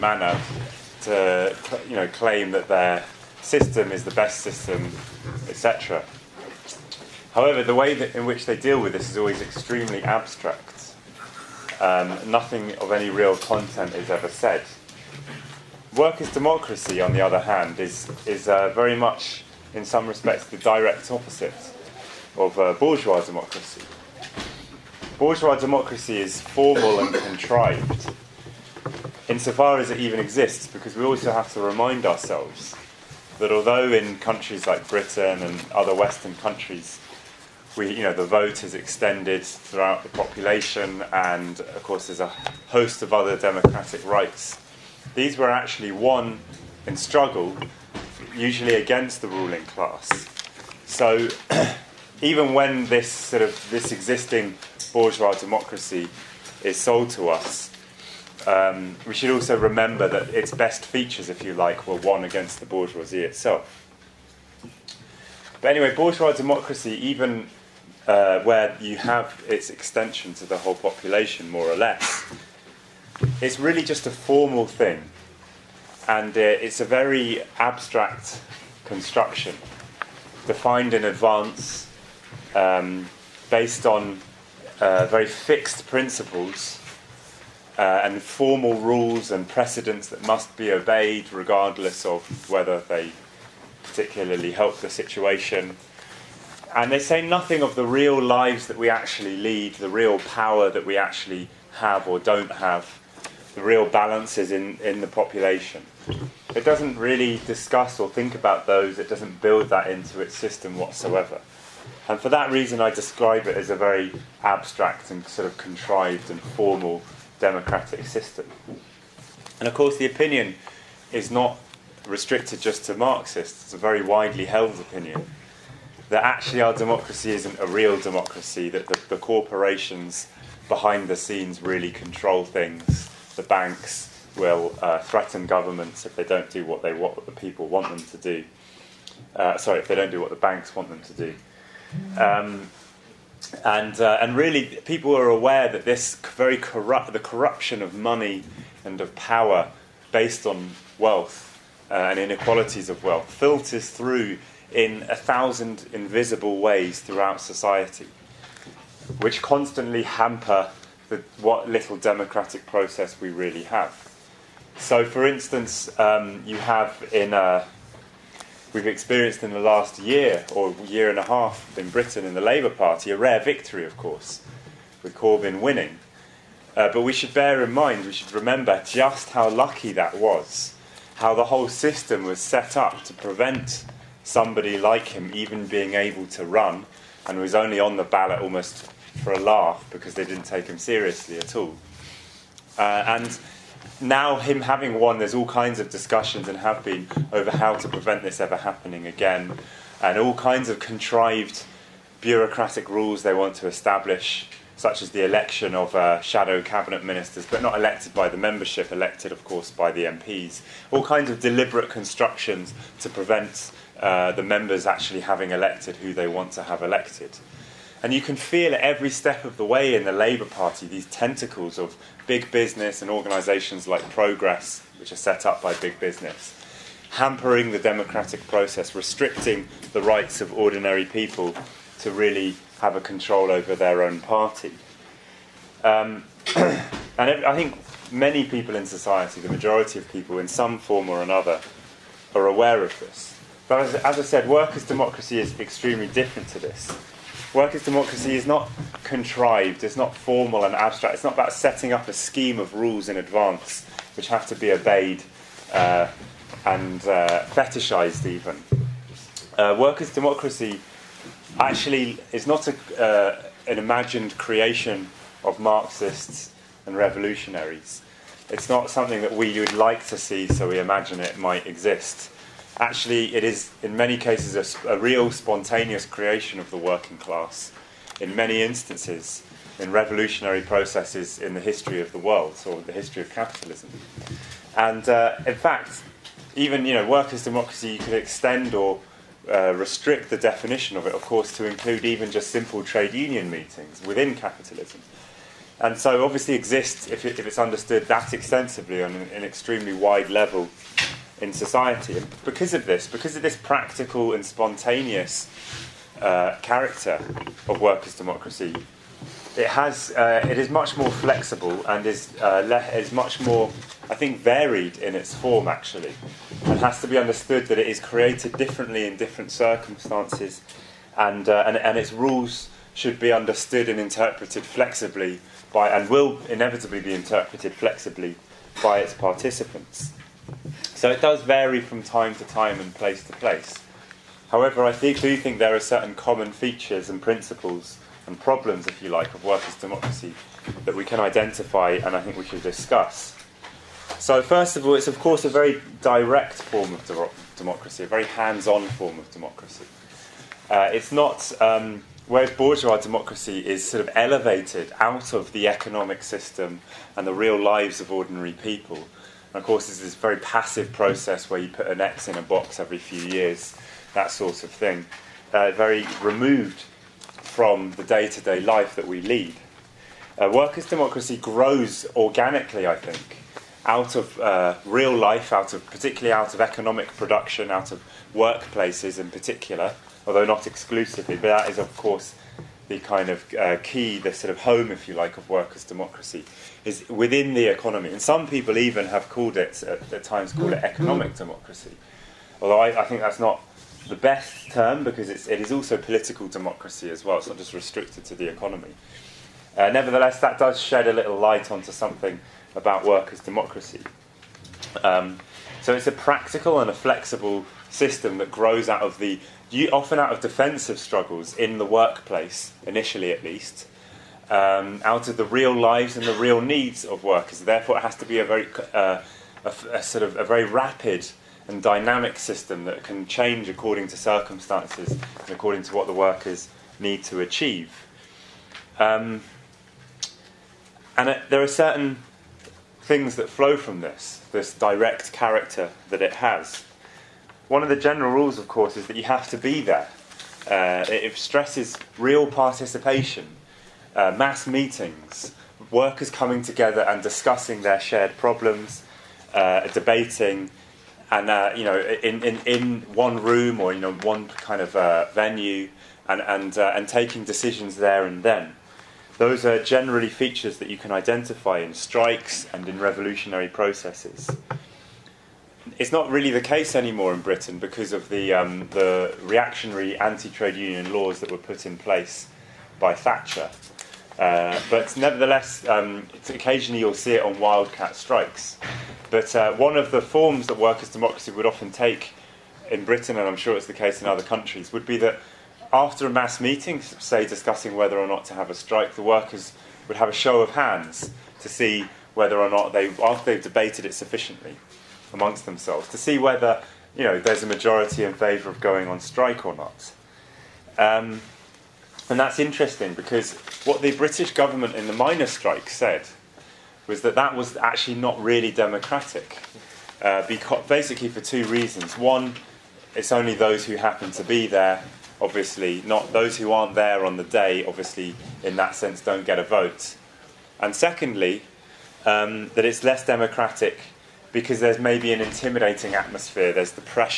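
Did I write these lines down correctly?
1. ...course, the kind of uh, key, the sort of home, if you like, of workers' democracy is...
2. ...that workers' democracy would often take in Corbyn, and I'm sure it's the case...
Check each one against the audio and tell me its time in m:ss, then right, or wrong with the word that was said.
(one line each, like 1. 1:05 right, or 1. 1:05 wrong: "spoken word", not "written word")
1. 6:21 right
2. 8:00 wrong: "Britain", not "Corbyn".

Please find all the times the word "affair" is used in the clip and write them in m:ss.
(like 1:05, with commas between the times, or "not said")
not said.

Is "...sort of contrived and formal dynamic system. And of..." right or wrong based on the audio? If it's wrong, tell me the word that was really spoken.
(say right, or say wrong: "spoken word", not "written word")
wrong: "democratic", not "dynamic".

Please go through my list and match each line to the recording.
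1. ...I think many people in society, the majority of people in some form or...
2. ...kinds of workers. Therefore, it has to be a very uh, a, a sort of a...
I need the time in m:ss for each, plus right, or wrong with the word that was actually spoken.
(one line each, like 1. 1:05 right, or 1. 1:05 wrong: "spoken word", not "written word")
1. 3:57 right
2. 6:56 wrong: "needs", not "kinds".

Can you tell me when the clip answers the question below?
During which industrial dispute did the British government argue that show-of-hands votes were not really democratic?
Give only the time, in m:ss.
8:25.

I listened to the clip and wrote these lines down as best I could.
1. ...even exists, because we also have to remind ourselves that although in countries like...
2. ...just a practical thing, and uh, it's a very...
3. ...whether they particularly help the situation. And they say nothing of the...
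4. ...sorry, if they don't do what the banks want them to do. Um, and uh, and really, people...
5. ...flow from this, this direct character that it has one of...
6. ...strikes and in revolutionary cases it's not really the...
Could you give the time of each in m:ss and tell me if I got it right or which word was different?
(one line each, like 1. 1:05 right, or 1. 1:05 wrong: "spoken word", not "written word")
1. 0:29 right
2. 1:13 wrong: "formal", not "practical"
3. 1:32 right
4. 2:19 right
5. 7:13 right
6. 7:41 wrong: "processes", not "cases".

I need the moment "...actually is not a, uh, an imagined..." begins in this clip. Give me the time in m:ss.
4:21.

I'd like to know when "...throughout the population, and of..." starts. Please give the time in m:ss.
0:39.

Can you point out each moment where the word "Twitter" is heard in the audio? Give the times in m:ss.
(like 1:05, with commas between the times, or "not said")
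not said.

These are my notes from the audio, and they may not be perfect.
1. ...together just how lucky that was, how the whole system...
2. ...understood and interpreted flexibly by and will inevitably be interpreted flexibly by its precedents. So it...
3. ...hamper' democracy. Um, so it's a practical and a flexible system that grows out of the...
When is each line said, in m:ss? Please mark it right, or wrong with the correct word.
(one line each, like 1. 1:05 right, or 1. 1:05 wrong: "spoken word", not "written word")
1. 2:58 wrong: "remember", not "together"
2. 5:23 wrong: "participants", not "precedents"
3. 6:43 wrong: "workers", not "hamper".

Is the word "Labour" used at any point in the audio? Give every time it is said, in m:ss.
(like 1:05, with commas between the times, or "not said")
2:52, 3:40.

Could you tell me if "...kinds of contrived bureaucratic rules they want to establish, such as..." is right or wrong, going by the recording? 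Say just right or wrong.
right.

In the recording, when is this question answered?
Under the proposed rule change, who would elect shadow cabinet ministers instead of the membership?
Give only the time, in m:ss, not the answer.
3:29.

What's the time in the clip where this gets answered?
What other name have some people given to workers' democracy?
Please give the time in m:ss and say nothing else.
6:30.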